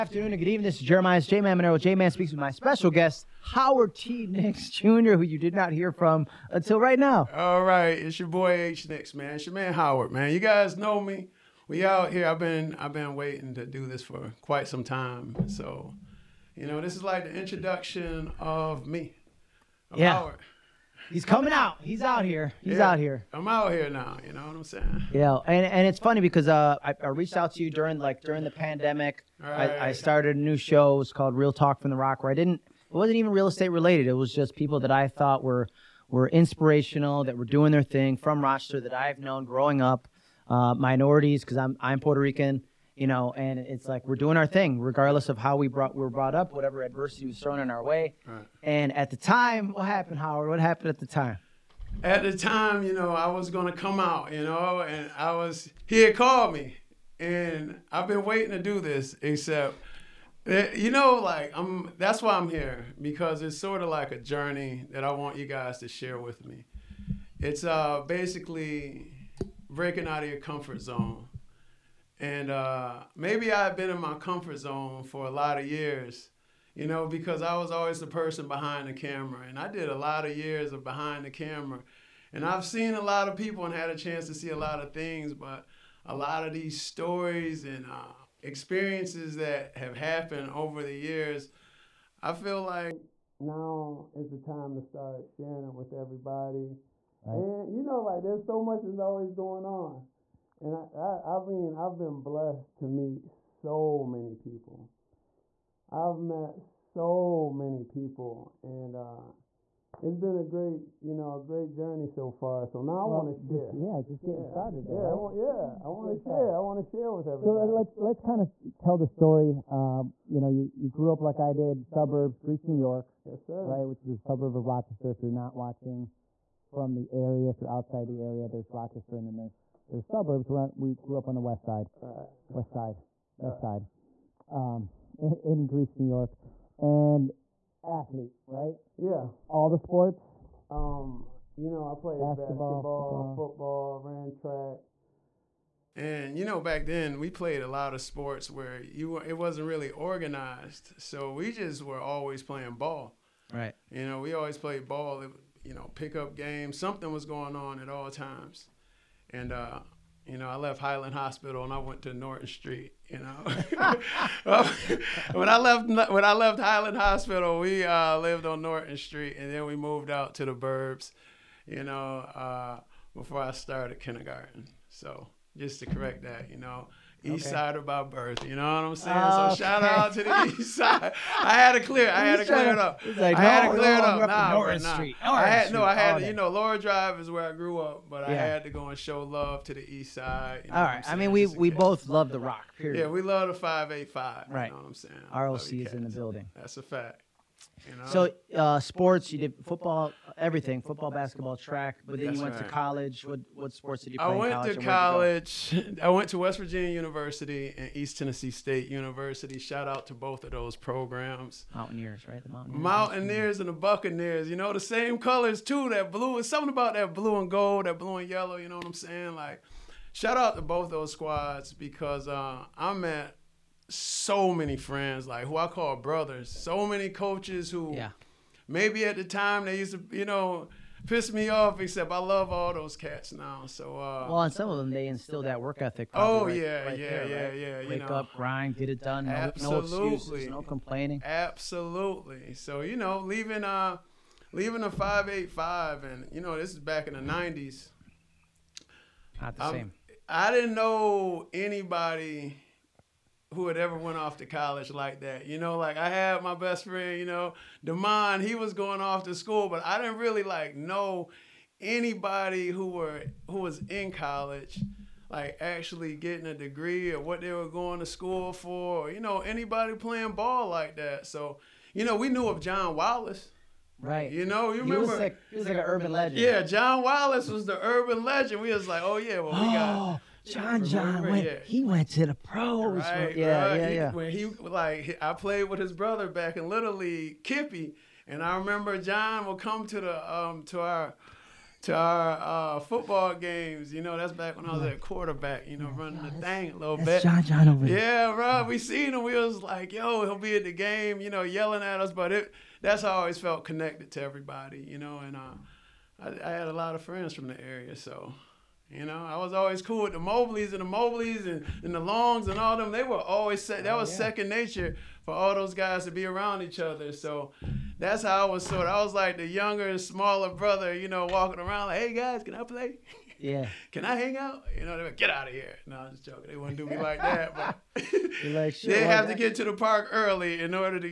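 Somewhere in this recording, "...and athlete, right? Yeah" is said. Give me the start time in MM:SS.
02:16.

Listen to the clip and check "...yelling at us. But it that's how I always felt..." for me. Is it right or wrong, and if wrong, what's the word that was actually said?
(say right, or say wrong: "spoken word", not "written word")
right.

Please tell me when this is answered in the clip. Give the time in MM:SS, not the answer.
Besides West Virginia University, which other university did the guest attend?
03:27.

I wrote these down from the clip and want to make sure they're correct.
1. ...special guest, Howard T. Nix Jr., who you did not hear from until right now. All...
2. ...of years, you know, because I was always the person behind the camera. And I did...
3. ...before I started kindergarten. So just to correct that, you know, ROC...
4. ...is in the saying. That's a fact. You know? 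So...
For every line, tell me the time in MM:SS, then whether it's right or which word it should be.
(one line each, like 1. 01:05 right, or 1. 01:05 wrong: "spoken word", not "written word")
1. 00:02 right
2. 01:15 right
3. 02:53 wrong: "East", not "ROC"
4. 03:15 wrong: "building", not "saying".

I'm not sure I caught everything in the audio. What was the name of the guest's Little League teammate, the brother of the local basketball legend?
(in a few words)
Kippy.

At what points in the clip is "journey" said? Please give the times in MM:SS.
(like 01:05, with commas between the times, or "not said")
01:04, 01:51.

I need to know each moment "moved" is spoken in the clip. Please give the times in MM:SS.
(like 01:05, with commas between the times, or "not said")
02:49.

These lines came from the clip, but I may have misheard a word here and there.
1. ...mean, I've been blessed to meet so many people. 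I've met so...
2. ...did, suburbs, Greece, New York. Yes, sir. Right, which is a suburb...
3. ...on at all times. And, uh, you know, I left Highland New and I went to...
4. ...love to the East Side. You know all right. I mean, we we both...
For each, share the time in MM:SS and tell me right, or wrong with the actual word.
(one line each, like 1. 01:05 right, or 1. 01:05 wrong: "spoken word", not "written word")
1. 01:41 right
2. 02:01 right
3. 02:37 wrong: "Hospital", not "New"
4. 03:09 right.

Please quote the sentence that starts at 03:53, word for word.
So uh, Well and some of them they instill that work ethic.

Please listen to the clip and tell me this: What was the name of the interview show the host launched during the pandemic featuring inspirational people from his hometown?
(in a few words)
Real Talk from the ROC.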